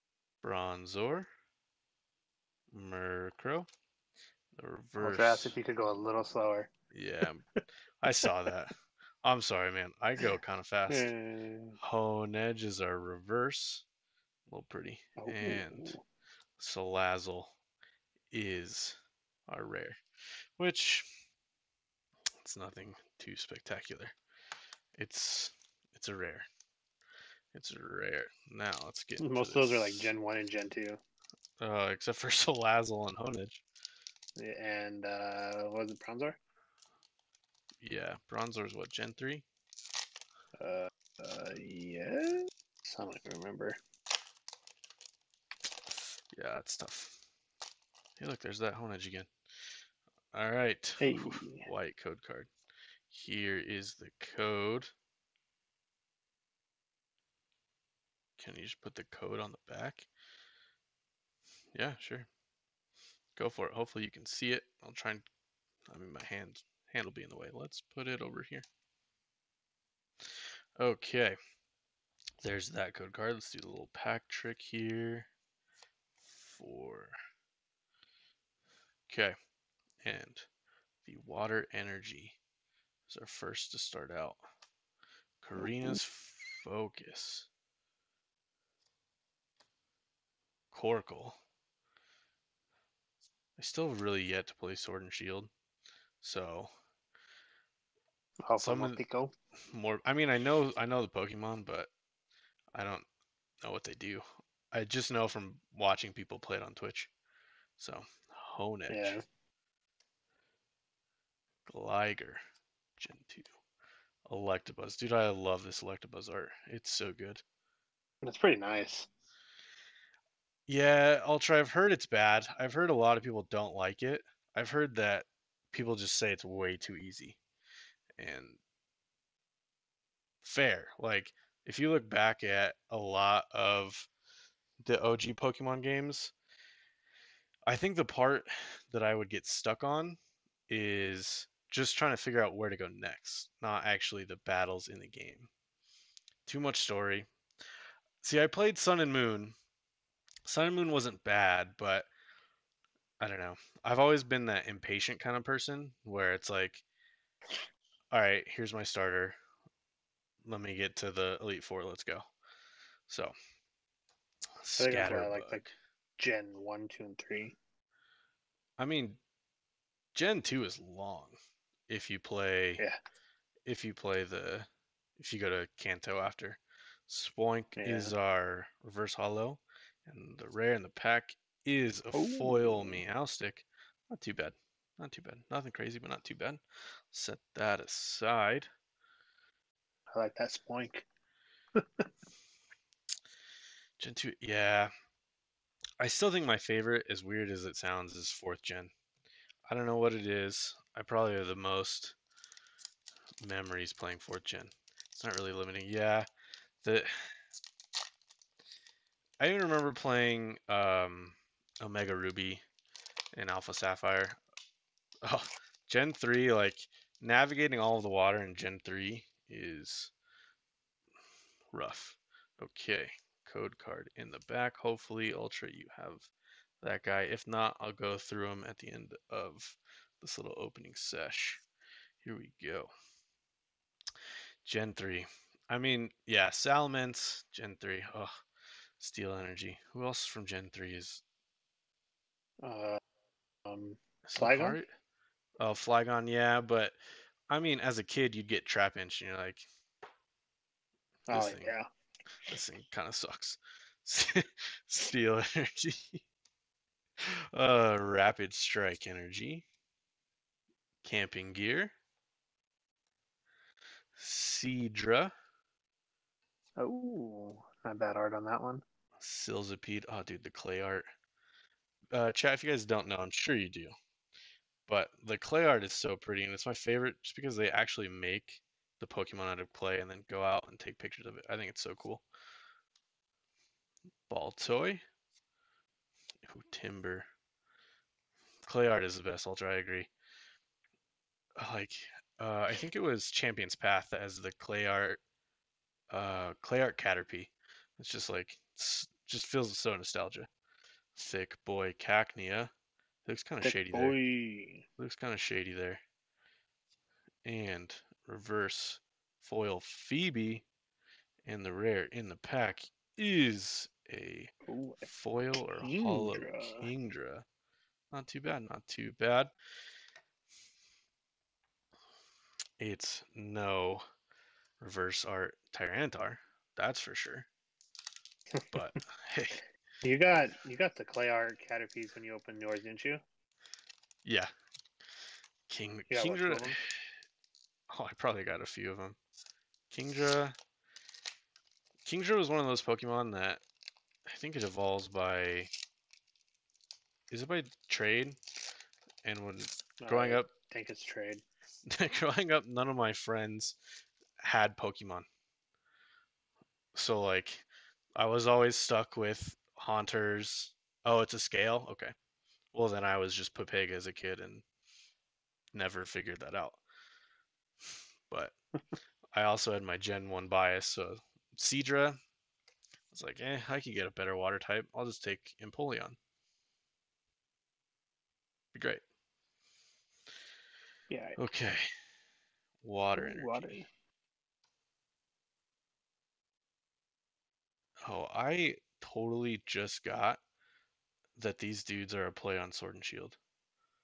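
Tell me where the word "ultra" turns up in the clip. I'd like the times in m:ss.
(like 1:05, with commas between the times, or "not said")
2:01, 3:45, 4:49.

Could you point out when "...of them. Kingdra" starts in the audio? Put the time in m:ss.
5:38.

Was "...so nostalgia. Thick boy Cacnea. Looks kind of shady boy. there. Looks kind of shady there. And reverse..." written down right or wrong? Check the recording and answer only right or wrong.
right.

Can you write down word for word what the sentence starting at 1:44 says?
I just know from watching people play it on Twitch.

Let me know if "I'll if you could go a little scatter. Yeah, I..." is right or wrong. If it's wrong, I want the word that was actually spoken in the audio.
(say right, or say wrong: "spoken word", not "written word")
wrong: "slower", not "scatter".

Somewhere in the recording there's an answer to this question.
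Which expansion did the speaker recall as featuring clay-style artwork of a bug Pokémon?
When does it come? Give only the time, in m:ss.
4:53.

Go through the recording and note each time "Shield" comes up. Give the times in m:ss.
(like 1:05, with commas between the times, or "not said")
1:35, 6:33.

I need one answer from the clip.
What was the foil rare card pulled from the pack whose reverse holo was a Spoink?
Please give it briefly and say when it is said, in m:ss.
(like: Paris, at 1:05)
Meowstic, at 3:02.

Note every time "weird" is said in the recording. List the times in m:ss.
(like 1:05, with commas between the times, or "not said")
3:17.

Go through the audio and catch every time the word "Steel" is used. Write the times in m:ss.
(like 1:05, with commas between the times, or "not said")
3:58, 4:14.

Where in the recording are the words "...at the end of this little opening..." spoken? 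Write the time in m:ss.
3:48.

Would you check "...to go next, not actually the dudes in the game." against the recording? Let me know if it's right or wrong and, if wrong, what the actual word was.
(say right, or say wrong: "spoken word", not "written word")
wrong: "battles", not "dudes".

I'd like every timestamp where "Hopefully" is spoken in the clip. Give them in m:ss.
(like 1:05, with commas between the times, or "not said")
1:03, 3:44.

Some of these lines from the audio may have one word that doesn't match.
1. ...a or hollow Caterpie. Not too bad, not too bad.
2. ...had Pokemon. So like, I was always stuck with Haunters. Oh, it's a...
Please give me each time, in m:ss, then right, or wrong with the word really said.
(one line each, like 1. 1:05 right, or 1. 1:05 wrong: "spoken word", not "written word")
1. 5:15 wrong: "Kingdra", not "Caterpie"
2. 5:54 right.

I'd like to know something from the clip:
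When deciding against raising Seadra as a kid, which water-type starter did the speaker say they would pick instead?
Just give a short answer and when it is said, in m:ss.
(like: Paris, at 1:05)
Empoleon, at 6:15.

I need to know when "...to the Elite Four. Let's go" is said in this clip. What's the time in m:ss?
2:40.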